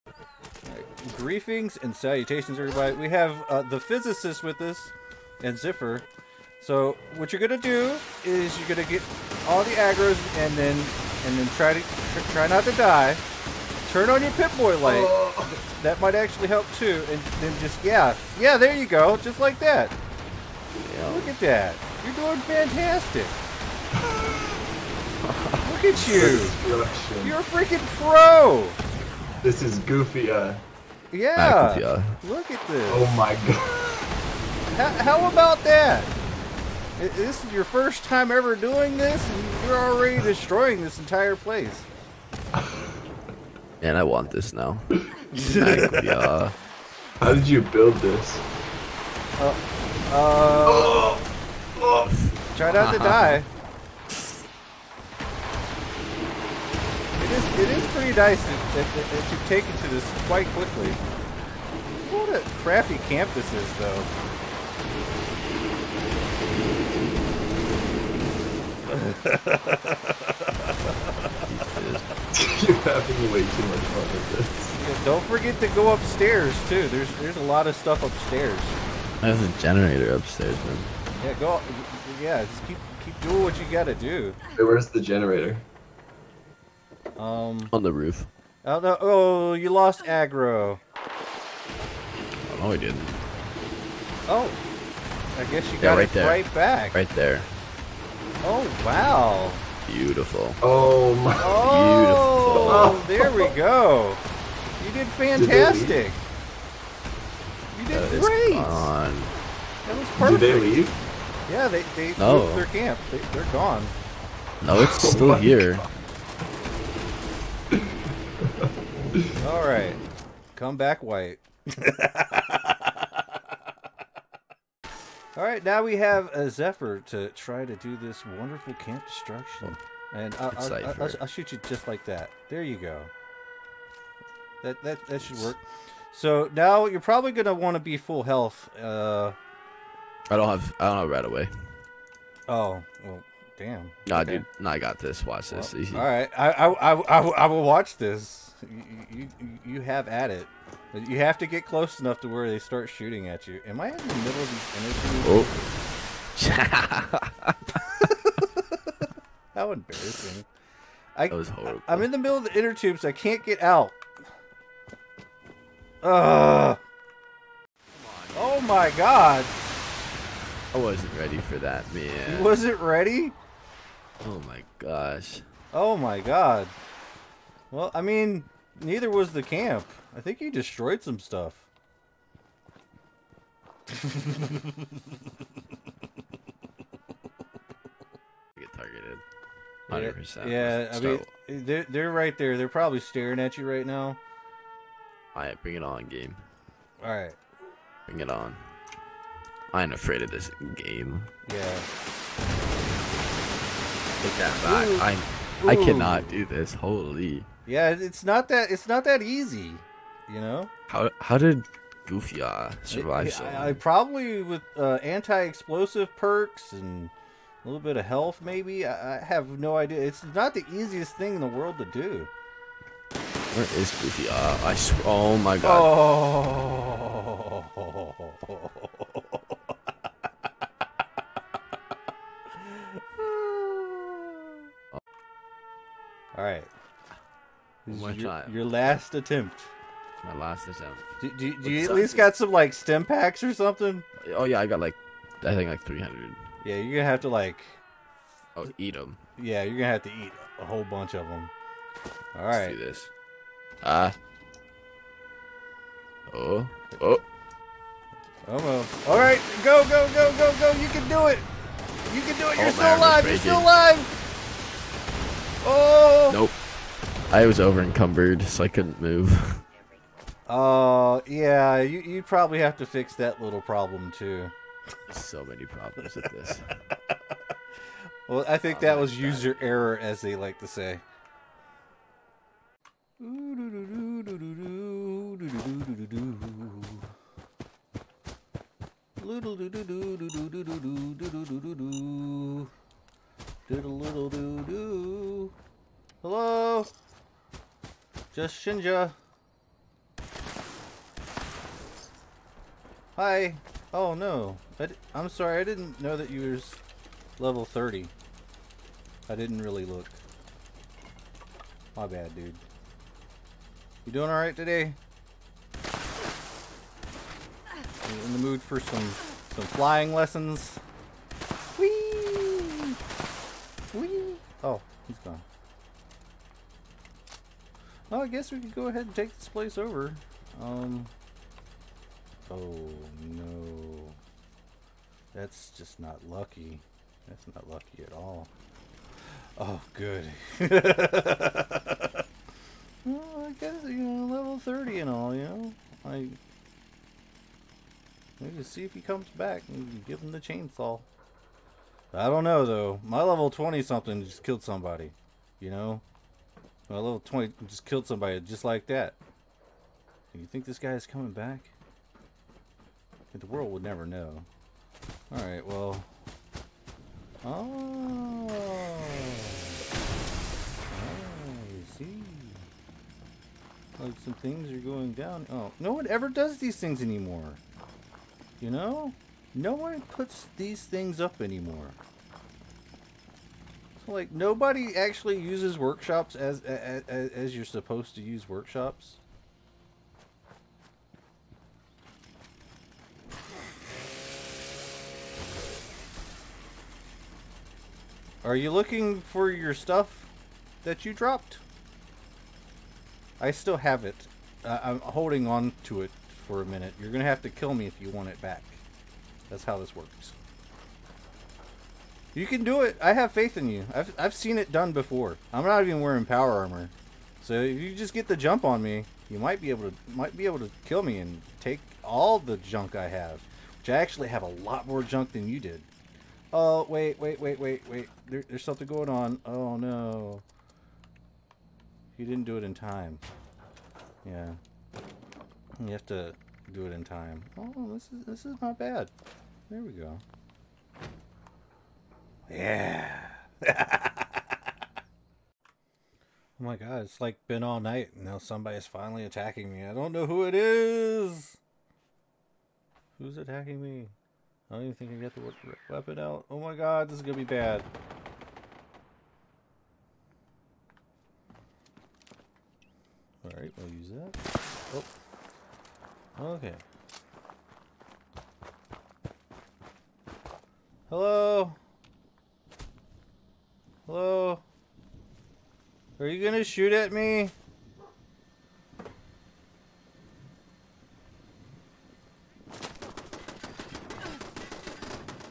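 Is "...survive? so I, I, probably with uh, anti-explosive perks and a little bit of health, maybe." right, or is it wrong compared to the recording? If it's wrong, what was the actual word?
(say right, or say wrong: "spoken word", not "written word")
right.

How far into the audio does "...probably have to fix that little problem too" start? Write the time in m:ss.
4:32.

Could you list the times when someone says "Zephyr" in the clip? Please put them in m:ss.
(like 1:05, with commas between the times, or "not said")
2:06.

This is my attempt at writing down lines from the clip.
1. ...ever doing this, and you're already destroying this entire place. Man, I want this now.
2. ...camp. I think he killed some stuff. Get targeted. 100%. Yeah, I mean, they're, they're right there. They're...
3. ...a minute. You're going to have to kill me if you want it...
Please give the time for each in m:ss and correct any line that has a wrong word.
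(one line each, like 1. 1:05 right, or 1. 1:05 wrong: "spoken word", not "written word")
1. 0:38 right
2. 2:59 wrong: "destroyed", not "killed"
3. 6:46 right.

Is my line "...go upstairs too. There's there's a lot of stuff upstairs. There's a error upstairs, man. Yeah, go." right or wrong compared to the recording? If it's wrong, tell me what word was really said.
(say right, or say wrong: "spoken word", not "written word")
wrong: "generator", not "error".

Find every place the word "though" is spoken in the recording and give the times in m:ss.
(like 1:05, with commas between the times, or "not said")
1:03, 5:52.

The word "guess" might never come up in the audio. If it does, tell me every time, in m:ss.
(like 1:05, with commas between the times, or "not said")
1:35, 5:28, 5:43.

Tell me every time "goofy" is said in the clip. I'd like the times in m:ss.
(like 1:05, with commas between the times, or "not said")
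0:29, 3:32, 3:44.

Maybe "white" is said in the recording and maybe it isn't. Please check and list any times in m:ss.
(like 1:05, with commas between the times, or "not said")
2:01.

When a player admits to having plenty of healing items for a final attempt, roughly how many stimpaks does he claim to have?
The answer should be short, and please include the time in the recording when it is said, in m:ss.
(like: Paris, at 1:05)
300, at 4:05.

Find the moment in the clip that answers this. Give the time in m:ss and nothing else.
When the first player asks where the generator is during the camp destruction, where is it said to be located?
1:27.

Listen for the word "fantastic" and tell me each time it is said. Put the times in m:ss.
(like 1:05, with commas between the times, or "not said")
0:22, 1:45.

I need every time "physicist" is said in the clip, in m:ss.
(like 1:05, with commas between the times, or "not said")
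0:03.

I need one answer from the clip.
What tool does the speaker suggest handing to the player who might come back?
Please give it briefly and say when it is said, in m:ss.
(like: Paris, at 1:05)
Chainsaw, at 5:50.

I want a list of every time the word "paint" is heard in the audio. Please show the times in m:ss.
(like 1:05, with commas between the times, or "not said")
not said.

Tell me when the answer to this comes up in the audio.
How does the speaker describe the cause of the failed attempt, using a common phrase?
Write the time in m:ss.
4:39.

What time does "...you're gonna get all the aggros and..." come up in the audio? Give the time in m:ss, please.
0:08.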